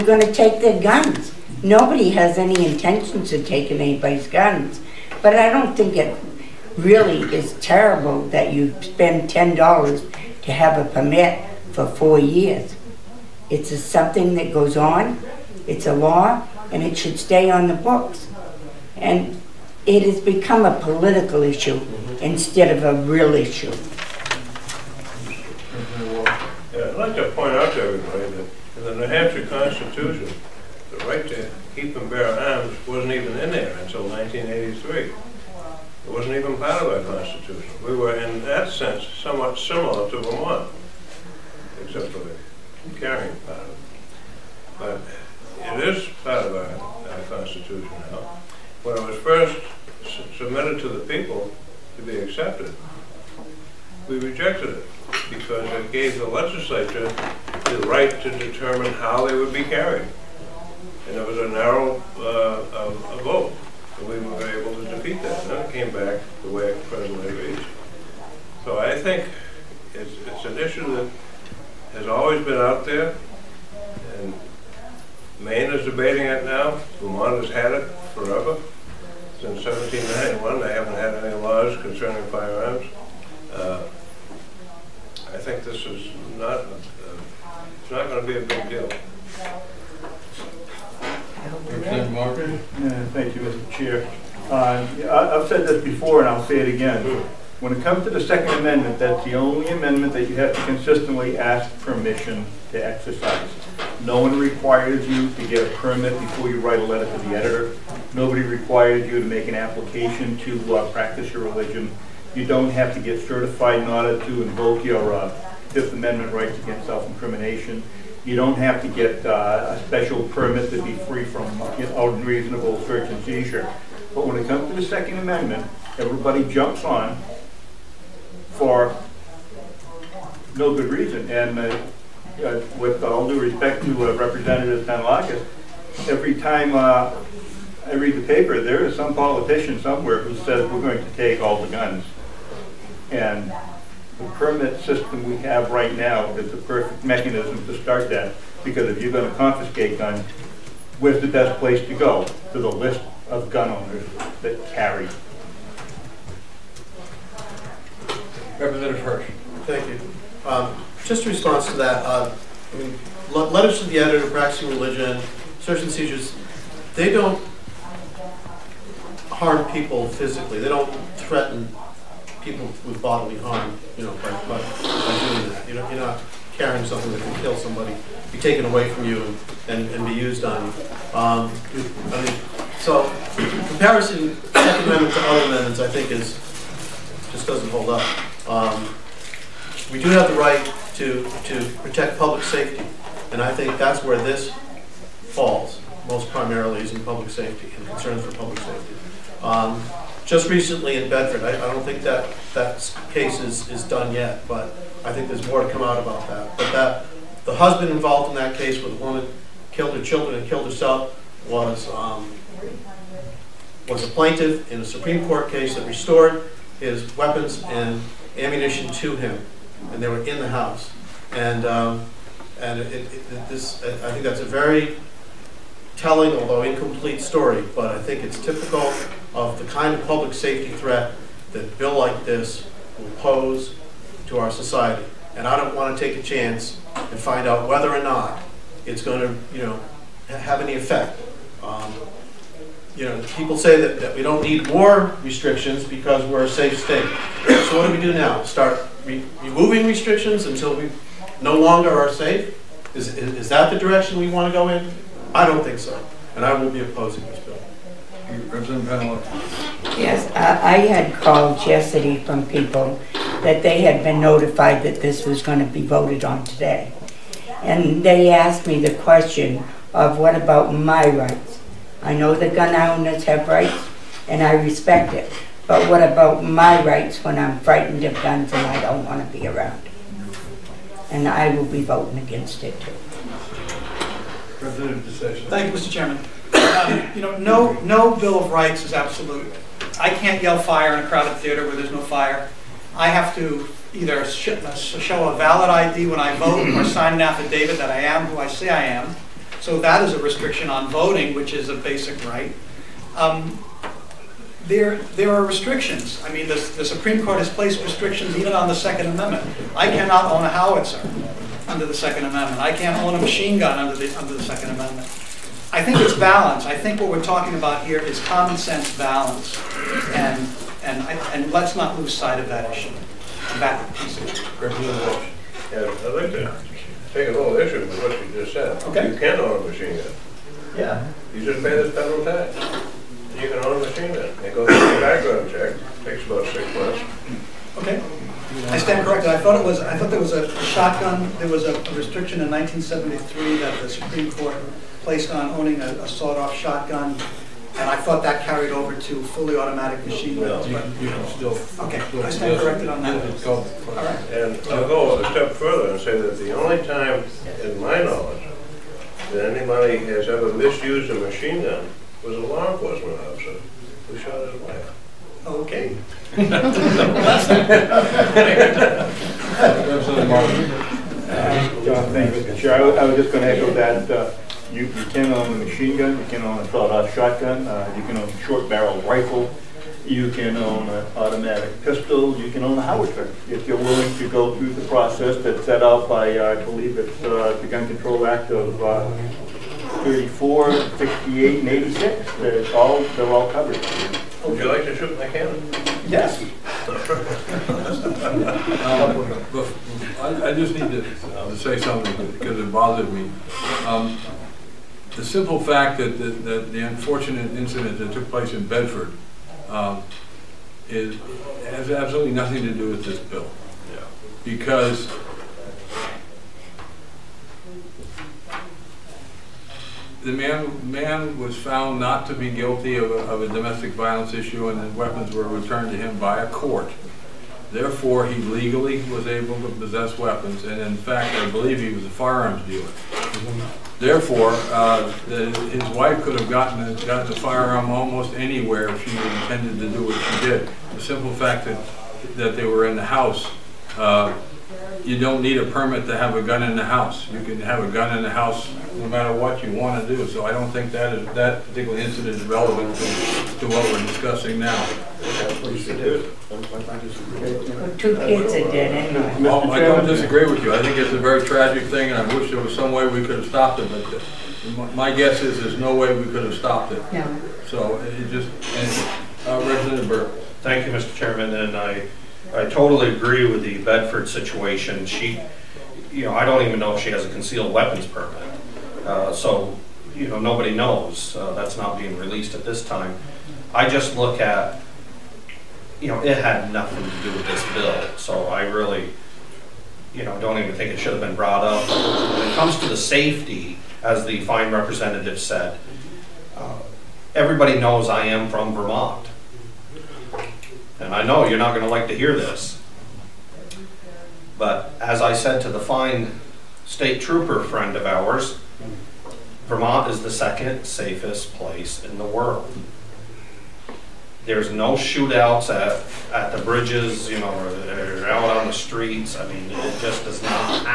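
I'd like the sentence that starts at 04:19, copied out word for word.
Yes, I, I had called yesterday from people that they had been notified that this was going to be voted on today.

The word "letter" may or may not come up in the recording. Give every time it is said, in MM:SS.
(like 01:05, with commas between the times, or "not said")
01:46, 02:43.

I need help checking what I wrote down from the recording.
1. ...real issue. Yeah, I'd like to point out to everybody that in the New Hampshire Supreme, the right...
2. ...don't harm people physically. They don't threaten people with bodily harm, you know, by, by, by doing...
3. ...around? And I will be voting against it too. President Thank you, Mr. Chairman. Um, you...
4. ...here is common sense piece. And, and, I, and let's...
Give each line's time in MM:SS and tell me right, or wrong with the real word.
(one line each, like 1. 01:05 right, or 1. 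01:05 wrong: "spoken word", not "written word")
1. 00:23 wrong: "Constitution", not "Supreme"
2. 02:47 right
3. 04:39 right
4. 05:17 wrong: "balance", not "piece".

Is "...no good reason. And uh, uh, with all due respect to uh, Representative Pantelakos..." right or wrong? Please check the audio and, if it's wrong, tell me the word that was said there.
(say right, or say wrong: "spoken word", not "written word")
right.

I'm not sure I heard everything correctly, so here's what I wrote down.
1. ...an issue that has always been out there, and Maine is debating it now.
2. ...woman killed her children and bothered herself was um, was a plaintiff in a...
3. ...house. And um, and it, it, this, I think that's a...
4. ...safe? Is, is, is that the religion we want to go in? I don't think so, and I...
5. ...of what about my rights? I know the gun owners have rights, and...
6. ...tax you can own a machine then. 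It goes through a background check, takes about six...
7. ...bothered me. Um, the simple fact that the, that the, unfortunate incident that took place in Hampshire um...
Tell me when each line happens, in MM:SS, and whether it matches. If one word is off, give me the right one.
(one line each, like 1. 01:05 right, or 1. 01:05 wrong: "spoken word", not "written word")
1. 01:10 right
2. 03:28 wrong: "killed", not "bothered"
3. 03:40 right
4. 04:12 wrong: "direction", not "religion"
5. 04:29 right
6. 05:32 right
7. 06:42 wrong: "Bedford", not "Hampshire".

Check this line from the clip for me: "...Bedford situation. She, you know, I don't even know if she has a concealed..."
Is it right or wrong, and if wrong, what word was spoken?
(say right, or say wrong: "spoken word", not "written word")
right.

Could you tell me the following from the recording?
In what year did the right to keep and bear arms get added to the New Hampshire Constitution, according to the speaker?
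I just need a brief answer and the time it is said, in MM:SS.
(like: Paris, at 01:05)
1983, at 00:34.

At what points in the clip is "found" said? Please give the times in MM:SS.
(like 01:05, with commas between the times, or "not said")
07:01.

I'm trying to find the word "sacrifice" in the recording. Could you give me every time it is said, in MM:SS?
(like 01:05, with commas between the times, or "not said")
not said.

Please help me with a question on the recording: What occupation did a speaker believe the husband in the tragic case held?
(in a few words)
firearms dealer.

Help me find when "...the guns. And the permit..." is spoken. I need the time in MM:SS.
02:21.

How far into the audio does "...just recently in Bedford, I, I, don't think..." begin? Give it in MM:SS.
03:20.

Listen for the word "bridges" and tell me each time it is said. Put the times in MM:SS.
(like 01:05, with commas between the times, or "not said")
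08:36.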